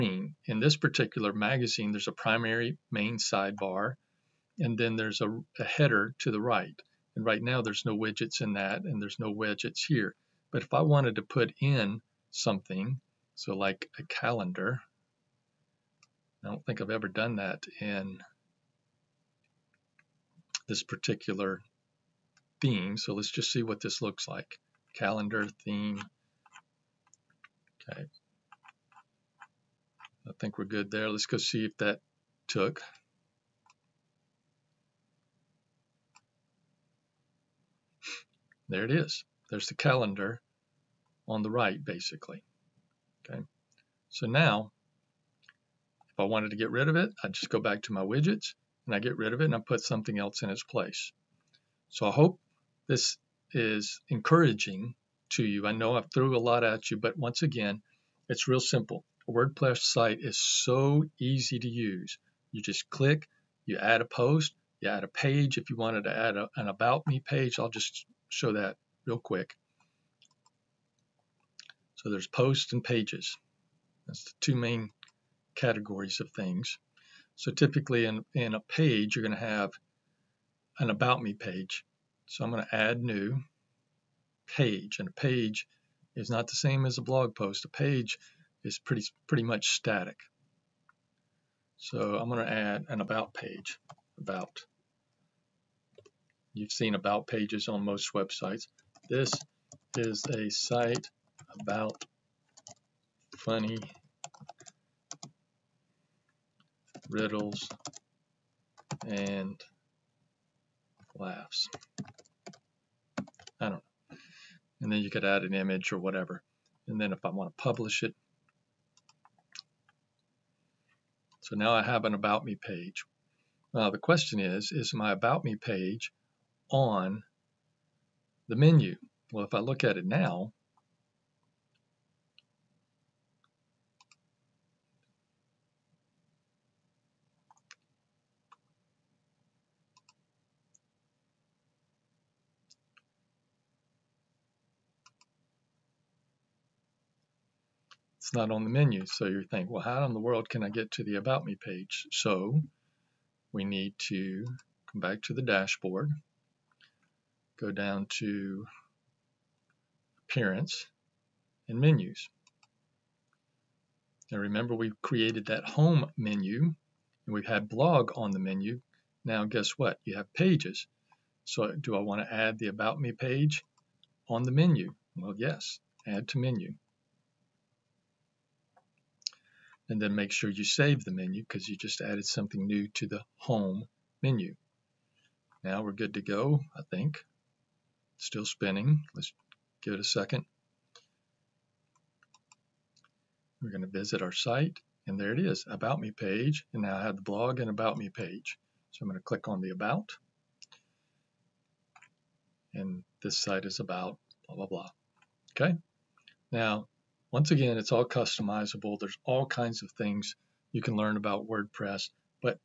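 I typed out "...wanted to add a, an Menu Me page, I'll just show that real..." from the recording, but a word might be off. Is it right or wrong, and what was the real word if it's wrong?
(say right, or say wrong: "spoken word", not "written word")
wrong: "About", not "Menu".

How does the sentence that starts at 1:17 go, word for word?
So typically in, in a page, you're going to have an About Me page.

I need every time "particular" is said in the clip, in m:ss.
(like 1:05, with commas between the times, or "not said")
0:00, 0:20.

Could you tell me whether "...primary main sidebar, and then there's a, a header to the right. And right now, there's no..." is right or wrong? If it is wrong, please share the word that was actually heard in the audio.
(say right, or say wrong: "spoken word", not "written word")
right.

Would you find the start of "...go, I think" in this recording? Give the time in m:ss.
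3:06.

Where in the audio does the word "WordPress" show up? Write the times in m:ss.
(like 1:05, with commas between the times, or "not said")
0:59, 3:31.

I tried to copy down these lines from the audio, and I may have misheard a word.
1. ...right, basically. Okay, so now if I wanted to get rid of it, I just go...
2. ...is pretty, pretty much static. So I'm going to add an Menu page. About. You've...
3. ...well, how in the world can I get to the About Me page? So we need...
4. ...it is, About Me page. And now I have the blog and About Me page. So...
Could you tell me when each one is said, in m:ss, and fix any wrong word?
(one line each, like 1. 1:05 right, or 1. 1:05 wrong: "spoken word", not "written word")
1. 0:41 right
2. 1:28 wrong: "About", not "Menu"
3. 2:29 right
4. 3:15 right.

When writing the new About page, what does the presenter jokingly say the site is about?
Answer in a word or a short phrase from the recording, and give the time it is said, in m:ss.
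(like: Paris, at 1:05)
Funny riddles and laughs, at 1:43.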